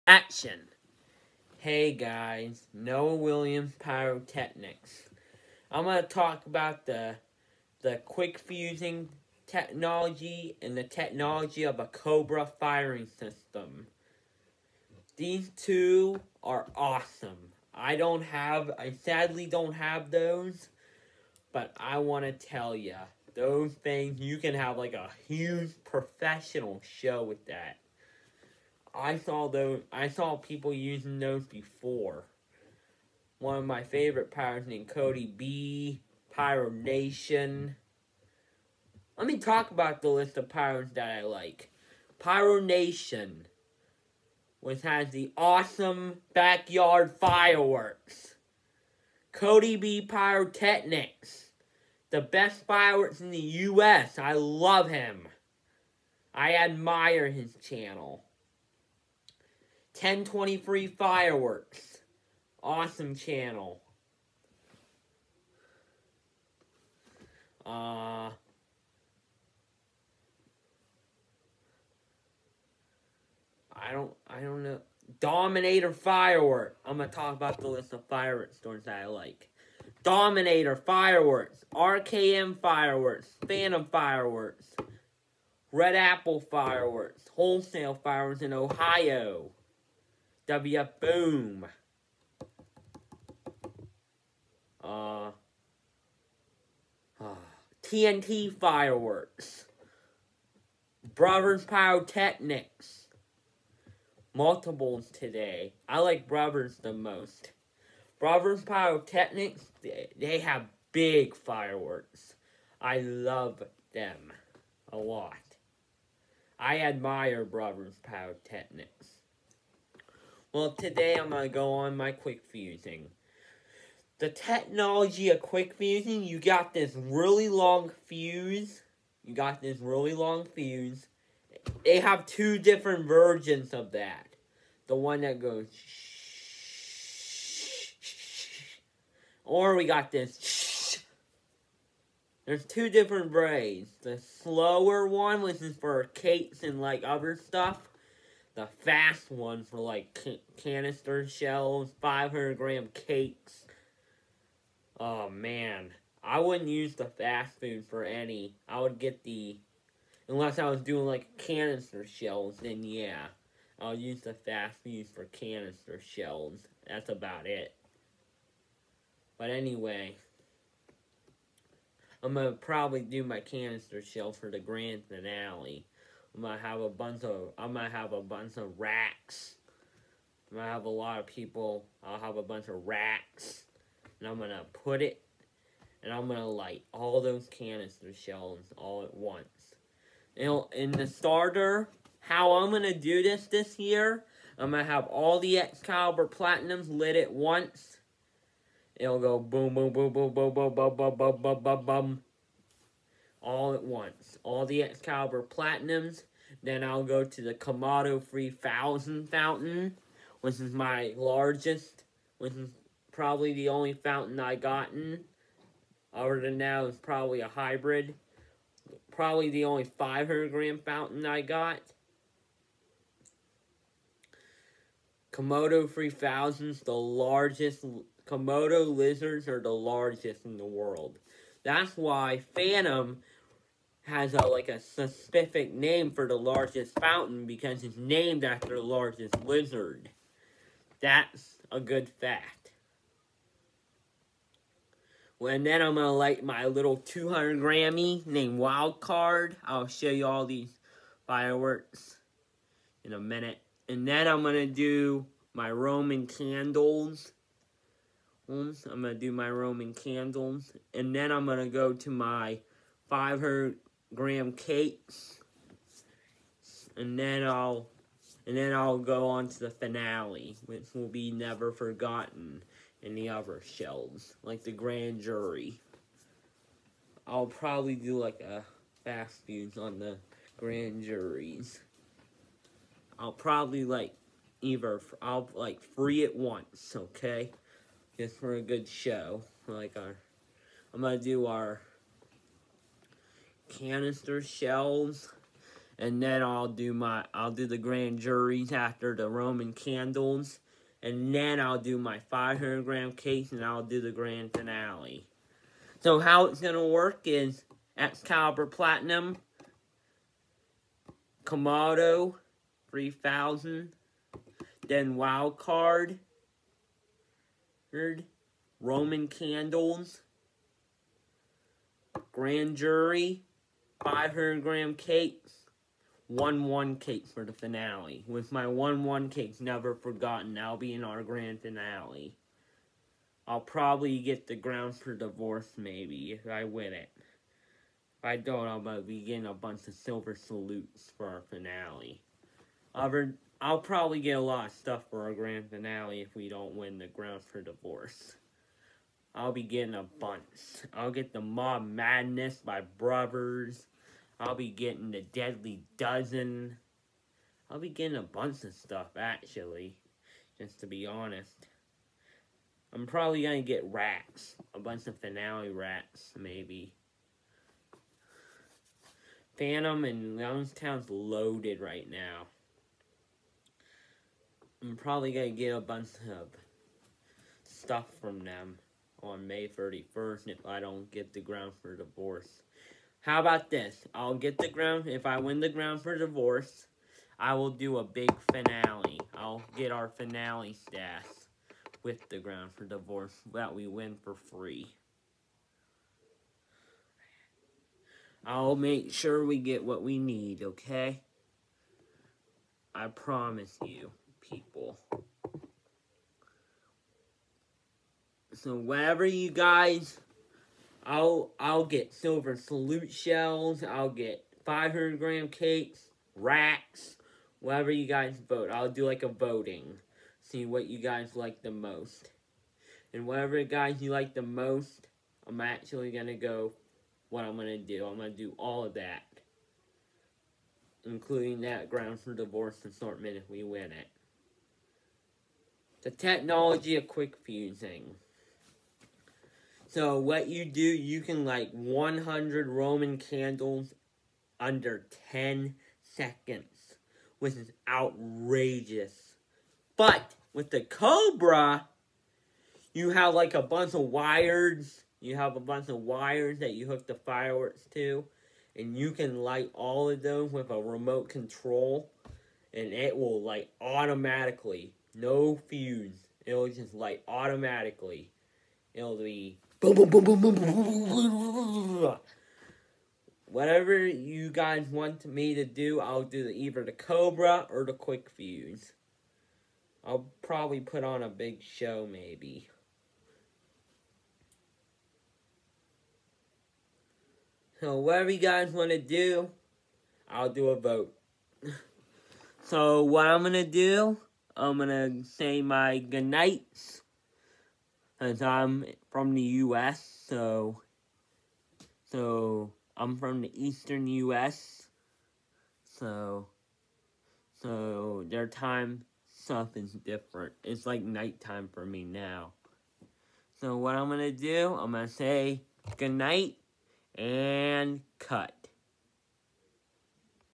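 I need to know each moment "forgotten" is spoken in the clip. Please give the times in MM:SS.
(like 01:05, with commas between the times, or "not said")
04:31, 05:29.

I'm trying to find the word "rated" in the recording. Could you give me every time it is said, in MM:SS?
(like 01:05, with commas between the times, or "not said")
not said.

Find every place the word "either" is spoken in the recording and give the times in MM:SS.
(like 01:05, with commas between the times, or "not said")
04:44, 07:56.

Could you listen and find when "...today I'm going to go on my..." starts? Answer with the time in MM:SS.
02:00.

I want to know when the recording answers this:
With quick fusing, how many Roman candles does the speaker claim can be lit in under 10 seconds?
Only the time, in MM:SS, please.
07:21.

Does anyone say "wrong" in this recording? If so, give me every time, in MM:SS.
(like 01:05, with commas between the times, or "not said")
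not said.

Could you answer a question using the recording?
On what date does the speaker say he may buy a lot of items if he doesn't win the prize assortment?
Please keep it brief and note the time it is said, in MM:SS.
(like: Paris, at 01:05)
May 31st, at 06:19.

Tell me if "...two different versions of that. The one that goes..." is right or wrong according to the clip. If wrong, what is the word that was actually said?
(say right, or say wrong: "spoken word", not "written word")
right.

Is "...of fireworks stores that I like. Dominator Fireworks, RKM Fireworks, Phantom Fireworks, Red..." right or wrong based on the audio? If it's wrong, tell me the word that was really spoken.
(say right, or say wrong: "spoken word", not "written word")
right.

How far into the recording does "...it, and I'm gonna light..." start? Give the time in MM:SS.
03:05.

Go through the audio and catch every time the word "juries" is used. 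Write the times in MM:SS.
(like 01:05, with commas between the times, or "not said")
04:41, 04:58.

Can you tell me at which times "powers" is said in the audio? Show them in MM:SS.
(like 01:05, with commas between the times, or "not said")
00:34, 00:40.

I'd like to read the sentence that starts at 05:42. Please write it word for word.
Other, I'll probably get a lot of stuff for our grand finale if we don't win the ground for divorce.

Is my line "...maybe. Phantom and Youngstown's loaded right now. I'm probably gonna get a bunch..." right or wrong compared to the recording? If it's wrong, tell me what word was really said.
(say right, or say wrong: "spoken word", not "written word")
right.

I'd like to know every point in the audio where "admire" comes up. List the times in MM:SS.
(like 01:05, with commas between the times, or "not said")
00:56, 01:56.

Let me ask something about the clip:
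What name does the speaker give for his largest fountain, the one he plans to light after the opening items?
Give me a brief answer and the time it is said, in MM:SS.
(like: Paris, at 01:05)
Komodo 3000, at 03:27.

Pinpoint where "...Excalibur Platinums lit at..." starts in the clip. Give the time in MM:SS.
03:15.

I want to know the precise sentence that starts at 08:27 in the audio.
So, their time stuff is different.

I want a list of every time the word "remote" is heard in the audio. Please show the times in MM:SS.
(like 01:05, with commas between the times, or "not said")
07:40.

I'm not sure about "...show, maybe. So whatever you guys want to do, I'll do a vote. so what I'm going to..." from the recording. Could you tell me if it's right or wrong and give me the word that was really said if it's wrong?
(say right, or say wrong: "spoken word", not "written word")
right.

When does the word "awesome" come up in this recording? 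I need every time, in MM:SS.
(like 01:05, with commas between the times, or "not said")
00:16, 00:45, 01:02.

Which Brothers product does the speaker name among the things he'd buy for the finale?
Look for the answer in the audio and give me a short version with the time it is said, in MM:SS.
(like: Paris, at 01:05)
Mob Madness, at 05:51.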